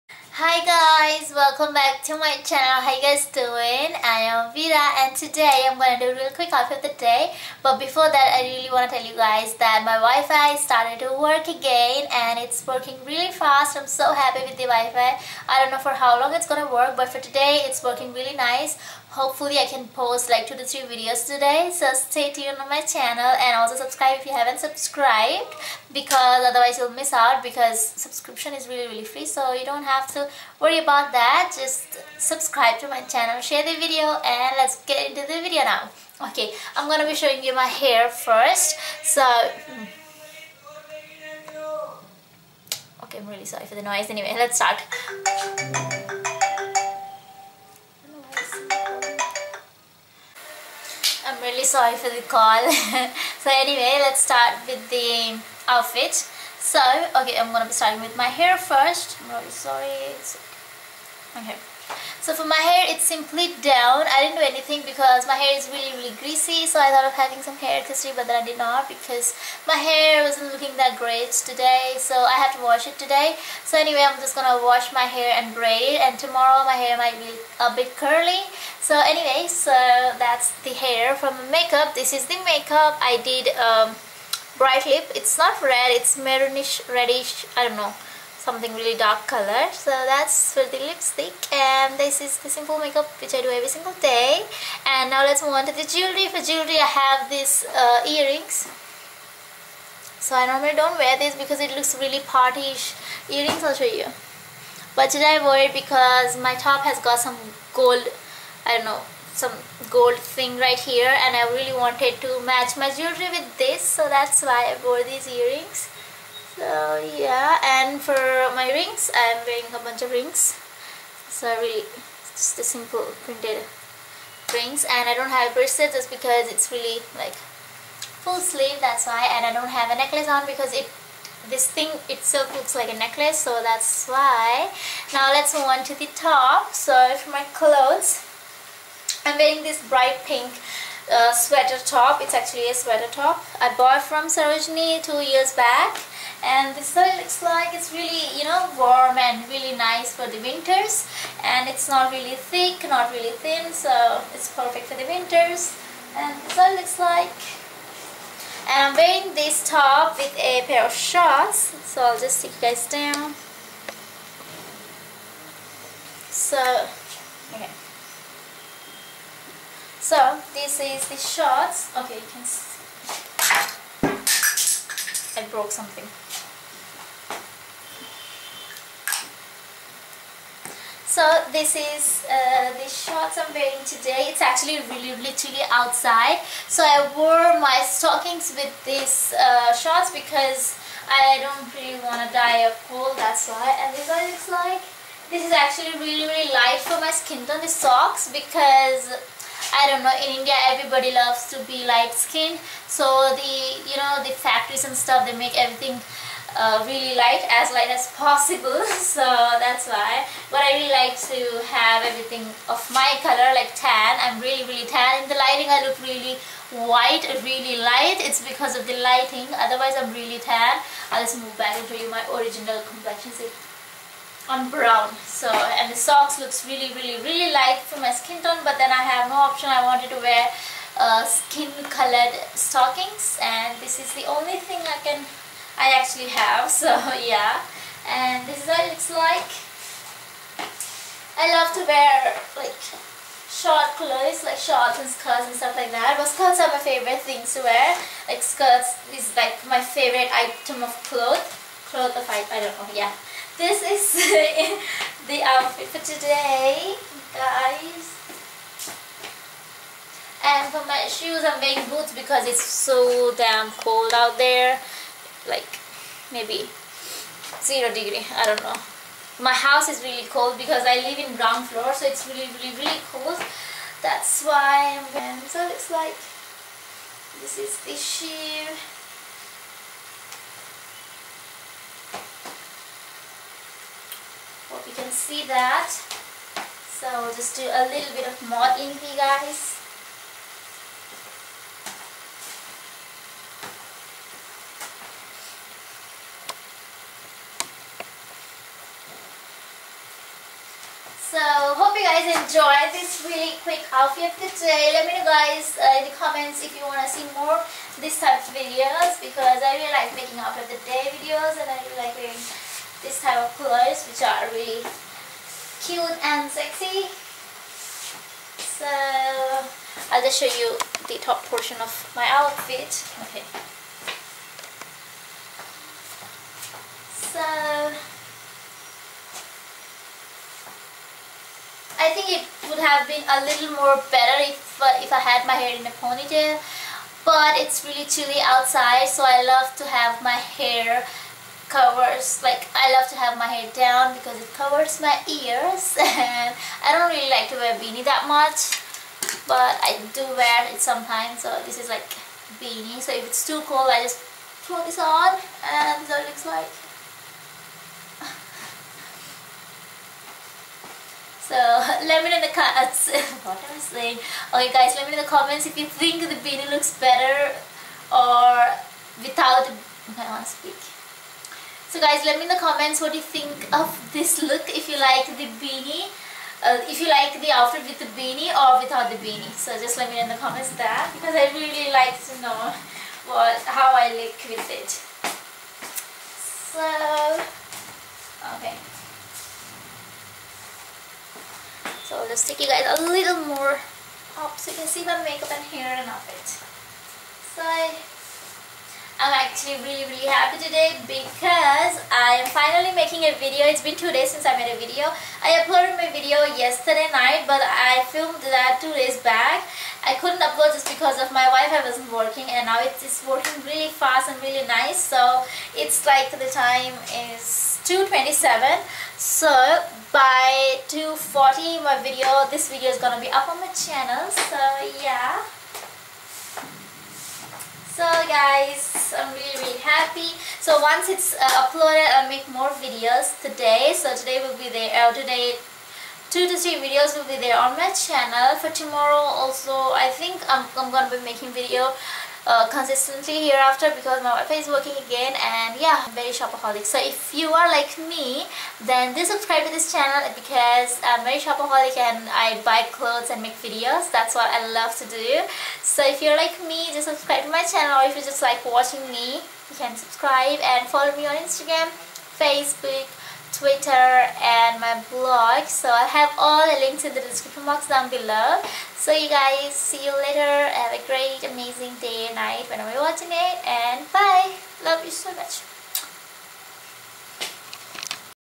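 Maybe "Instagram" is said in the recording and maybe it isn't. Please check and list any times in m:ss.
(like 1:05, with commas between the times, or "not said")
7:41.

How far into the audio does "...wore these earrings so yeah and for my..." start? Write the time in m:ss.
1:54.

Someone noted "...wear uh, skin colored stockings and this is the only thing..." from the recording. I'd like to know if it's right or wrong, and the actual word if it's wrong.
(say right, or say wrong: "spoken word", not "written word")
right.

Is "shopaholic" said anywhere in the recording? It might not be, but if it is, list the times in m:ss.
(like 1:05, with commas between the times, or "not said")
7:26, 7:31.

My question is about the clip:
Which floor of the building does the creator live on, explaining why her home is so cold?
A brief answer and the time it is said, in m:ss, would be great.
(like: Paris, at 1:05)
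Ground floor, at 4:31.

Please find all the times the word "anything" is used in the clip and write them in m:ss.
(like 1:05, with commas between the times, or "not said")
1:04.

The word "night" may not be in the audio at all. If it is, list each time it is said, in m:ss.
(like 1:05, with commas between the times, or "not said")
6:47, 7:52.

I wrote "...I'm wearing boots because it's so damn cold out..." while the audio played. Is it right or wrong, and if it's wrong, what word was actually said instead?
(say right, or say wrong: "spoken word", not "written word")
right.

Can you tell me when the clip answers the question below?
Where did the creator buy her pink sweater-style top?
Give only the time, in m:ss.
2:24.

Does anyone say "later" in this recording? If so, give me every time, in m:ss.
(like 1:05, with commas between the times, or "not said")
7:50.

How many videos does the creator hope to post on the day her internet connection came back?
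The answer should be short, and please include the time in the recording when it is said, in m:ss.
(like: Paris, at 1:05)
2 to 3, at 0:20.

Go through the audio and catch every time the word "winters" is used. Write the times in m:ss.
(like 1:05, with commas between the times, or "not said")
2:30, 2:35.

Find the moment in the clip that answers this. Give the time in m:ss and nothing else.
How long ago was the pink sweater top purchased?
2:25.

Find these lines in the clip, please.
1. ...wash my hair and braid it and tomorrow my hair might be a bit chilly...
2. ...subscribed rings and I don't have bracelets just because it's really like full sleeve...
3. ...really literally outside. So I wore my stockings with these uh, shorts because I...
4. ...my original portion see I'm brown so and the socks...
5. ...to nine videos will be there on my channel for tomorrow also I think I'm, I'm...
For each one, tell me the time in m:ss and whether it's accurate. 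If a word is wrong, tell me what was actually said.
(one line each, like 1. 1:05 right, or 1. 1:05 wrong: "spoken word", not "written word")
1. 1:14 wrong: "curly", not "chilly"
2. 2:03 wrong: "printed", not "subscribed"
3. 3:04 right
4. 3:42 wrong: "complexion", not "portion"
5. 7:16 wrong: "three", not "nine".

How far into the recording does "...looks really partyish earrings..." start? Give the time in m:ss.
1:41.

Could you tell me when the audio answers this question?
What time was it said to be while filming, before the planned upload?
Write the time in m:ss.
6:57.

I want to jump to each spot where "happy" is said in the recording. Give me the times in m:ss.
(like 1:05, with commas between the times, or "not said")
0:14, 6:40, 7:09.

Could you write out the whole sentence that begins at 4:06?
But skirts are my favorite things to wear.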